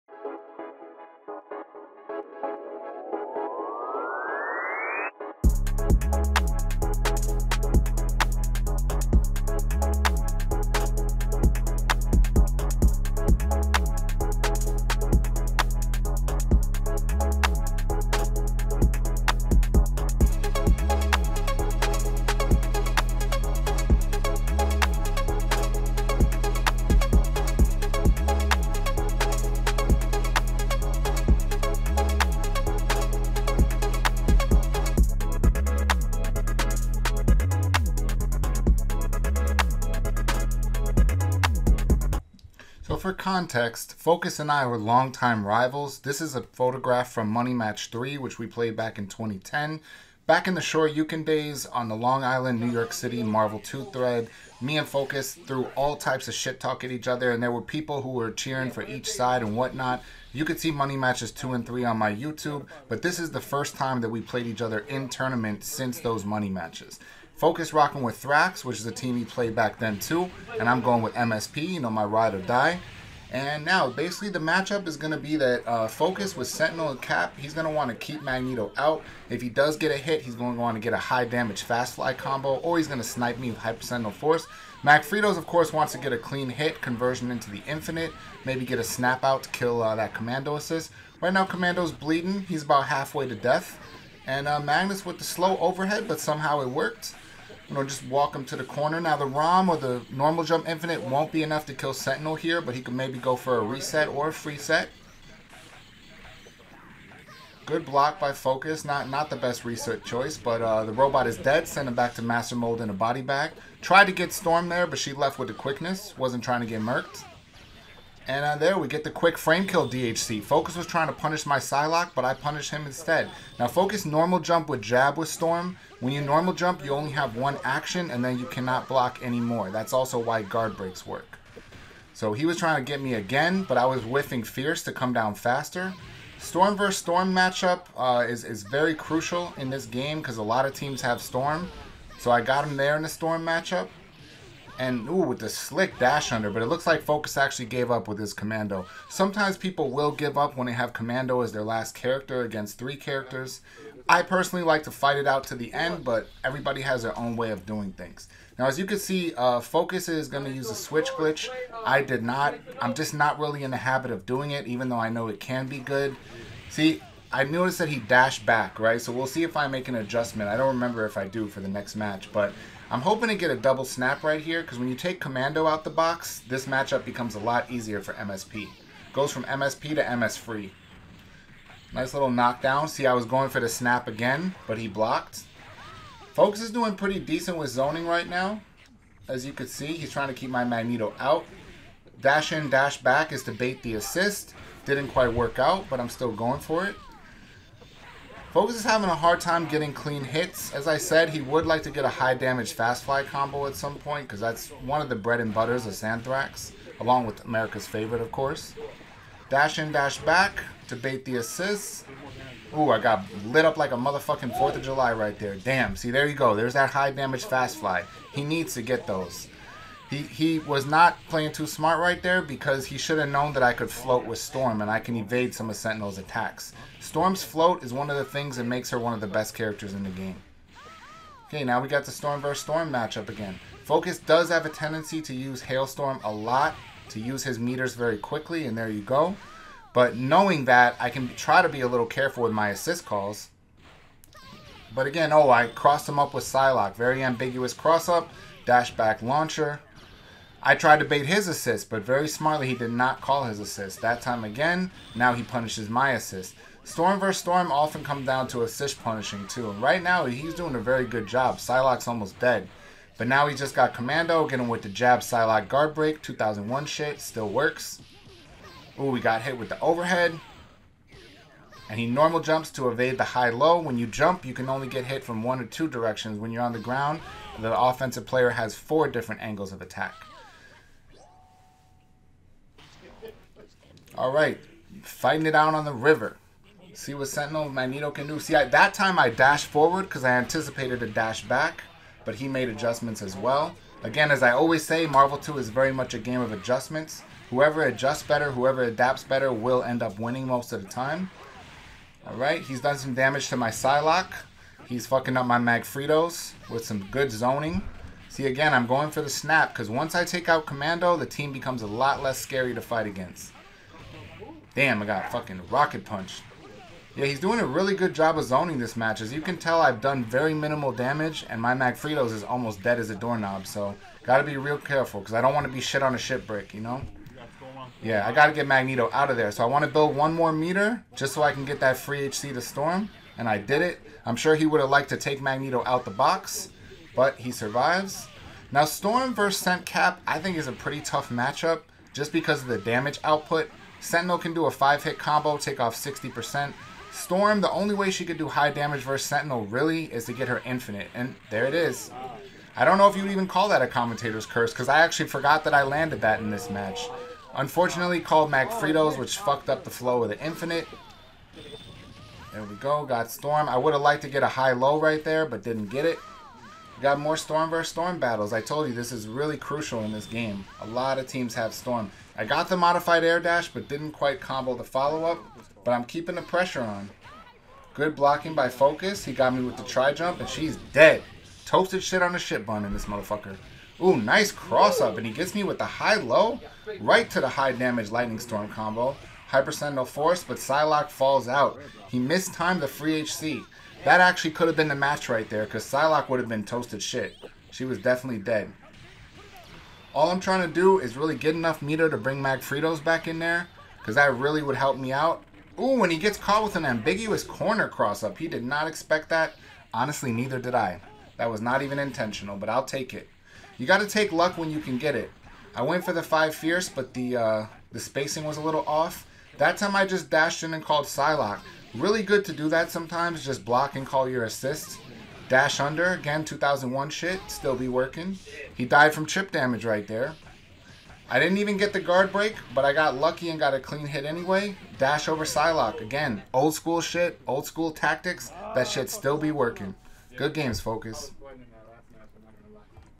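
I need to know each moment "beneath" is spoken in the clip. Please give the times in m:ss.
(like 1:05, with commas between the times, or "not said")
not said.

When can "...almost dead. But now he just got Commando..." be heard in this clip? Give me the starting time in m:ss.
4:22.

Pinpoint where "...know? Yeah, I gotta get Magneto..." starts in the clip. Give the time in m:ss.
5:26.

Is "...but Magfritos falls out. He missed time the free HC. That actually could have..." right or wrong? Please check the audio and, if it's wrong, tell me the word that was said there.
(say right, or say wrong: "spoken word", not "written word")
wrong: "Psylocke", not "Magfritos".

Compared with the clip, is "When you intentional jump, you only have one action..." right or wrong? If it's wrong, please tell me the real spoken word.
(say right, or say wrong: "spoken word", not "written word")
wrong: "normal", not "intentional".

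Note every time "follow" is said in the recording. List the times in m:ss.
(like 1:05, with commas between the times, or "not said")
6:14.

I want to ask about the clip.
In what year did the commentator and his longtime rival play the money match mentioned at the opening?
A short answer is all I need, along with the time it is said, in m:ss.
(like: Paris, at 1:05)
2010, at 0:49.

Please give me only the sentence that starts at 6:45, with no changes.
Ooh, when he gets caught with an ambiguous corner cross-up.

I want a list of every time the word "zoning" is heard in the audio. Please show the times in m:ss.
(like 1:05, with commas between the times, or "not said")
3:07, 5:07, 5:18.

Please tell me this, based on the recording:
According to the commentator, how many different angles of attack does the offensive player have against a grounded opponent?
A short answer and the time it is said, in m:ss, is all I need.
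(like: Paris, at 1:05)
4, at 4:38.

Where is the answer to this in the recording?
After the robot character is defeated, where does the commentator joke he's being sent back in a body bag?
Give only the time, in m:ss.
1:52.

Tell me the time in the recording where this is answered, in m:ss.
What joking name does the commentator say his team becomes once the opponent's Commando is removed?
3:00.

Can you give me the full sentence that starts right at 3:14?
Didn't quite work out, but I'm still going for it.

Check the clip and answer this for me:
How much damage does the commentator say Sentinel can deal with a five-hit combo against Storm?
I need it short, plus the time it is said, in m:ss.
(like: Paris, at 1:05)
60%, at 5:45.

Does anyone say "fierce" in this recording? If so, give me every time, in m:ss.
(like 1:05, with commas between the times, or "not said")
2:14, 6:56.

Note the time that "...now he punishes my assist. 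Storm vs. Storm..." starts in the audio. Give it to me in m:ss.
4:15.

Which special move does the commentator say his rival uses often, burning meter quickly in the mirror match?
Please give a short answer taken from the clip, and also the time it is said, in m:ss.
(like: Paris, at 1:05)
Hailstorm, at 3:55.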